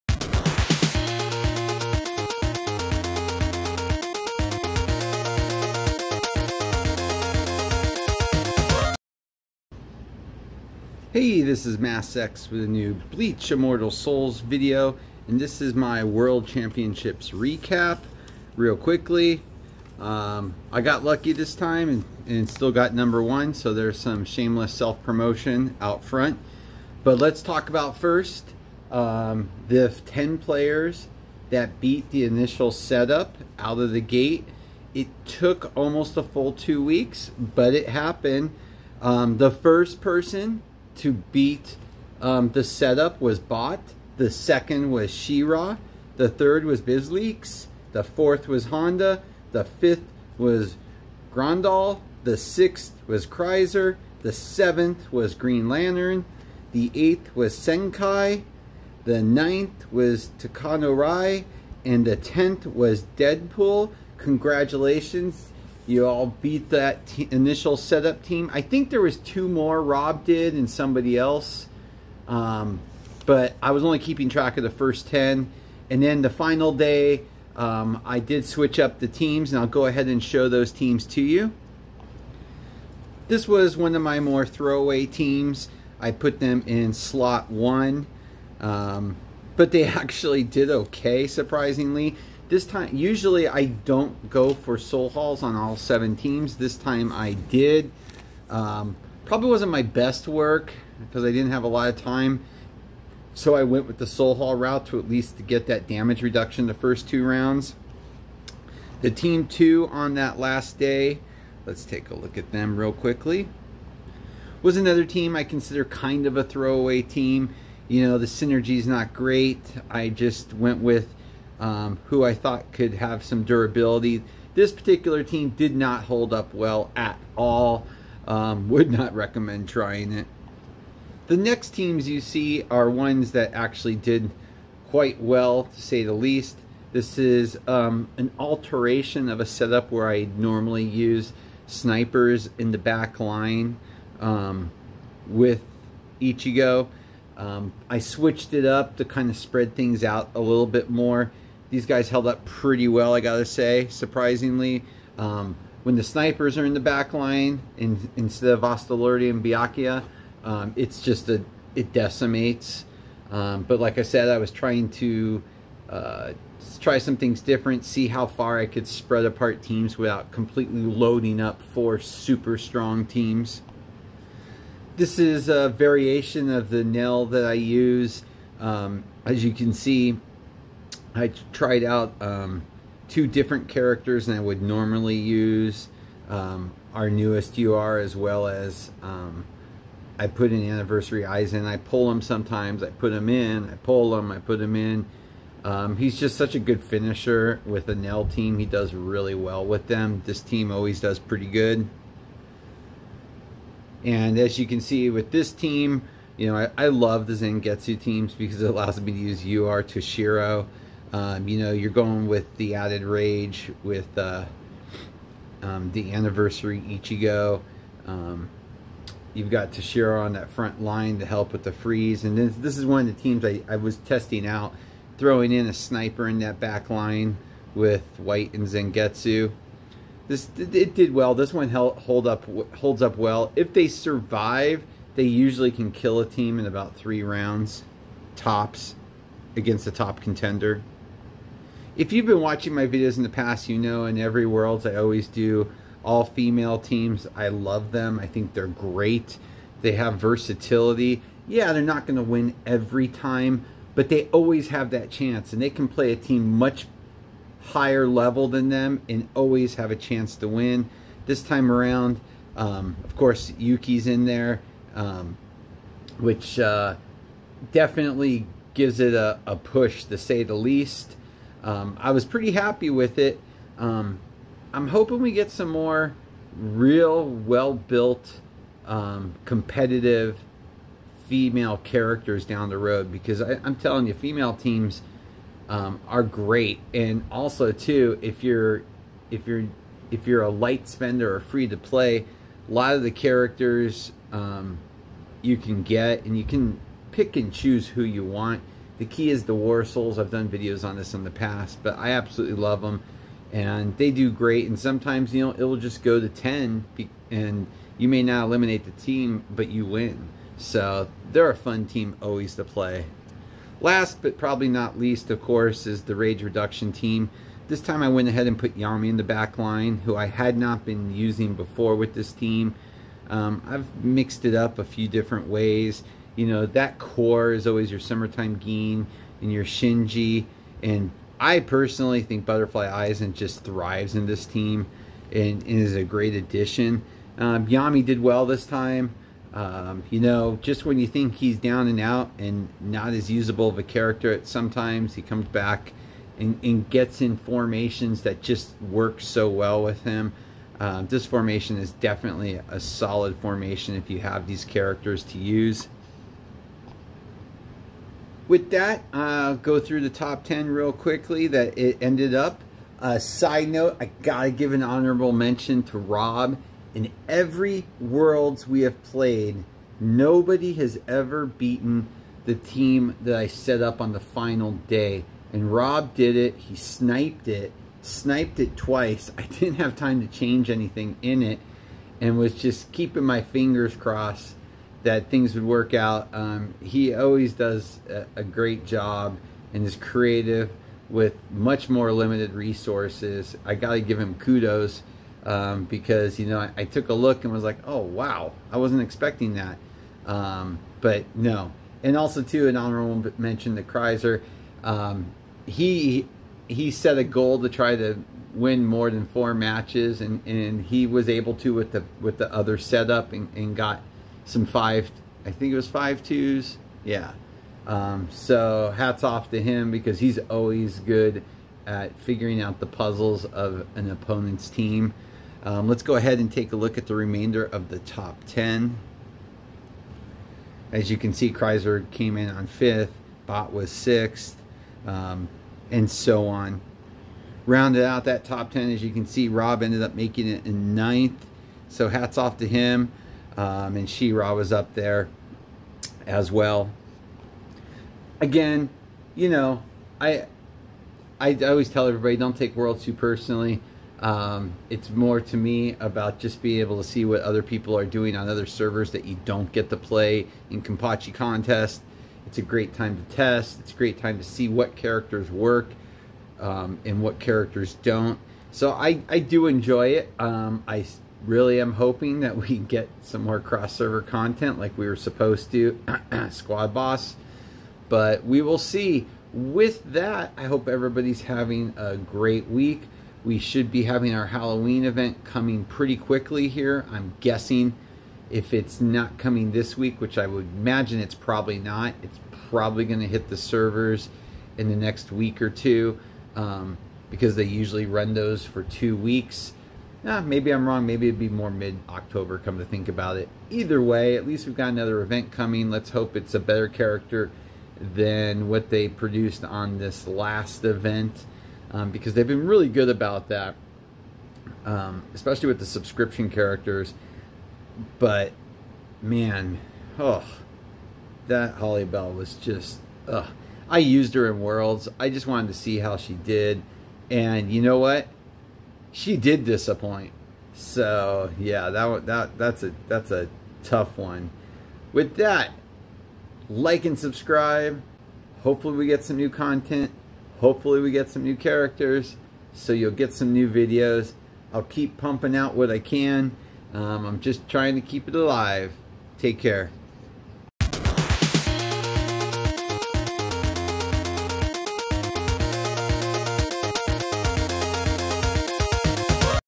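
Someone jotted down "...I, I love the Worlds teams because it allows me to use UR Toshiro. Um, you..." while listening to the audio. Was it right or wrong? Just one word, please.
wrong.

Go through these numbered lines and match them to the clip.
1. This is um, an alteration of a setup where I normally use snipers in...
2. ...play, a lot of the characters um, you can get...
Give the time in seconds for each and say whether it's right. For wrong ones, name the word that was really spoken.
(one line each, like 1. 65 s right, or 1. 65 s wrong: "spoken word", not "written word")
1. 136 s right
2. 291 s right.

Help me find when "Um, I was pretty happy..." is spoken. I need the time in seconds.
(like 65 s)
271 s.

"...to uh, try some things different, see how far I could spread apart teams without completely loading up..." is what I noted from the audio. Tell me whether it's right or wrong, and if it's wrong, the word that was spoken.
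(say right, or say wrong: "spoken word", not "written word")
right.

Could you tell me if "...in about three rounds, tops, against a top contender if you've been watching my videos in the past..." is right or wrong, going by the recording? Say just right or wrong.
right.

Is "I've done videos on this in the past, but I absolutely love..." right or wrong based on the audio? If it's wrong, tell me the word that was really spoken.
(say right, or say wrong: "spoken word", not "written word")
right.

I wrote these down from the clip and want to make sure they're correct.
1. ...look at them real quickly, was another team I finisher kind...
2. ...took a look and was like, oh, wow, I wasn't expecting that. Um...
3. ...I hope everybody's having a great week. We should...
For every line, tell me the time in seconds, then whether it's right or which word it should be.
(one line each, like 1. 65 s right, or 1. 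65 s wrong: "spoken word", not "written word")
1. 112 s wrong: "consider", not "finisher"
2. 396 s right
3. 480 s right.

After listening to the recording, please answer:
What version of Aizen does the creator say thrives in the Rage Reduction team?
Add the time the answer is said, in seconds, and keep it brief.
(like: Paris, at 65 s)
Butterfly Aizen, at 332 s.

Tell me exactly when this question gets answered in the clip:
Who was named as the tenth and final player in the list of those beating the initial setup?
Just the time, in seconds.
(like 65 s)
63 s.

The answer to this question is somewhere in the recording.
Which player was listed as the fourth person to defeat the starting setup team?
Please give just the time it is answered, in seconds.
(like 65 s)
48 s.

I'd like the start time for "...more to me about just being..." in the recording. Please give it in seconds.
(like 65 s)
455 s.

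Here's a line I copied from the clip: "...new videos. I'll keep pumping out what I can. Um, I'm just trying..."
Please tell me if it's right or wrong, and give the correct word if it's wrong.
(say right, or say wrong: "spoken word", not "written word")
right.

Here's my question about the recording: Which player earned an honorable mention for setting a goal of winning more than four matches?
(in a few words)
Kreiser.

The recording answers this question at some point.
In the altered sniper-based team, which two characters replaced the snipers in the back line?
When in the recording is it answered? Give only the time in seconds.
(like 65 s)
158 s.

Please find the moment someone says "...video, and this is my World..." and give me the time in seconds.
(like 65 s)
14 s.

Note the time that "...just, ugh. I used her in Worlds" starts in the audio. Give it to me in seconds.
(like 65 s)
522 s.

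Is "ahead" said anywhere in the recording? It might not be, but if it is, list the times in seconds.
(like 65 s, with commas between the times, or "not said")
79 s, 318 s, 426 s.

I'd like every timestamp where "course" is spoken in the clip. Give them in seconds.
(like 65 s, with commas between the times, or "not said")
263 s, 315 s.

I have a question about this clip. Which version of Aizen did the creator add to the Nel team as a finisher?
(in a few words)
anniversary Aizen.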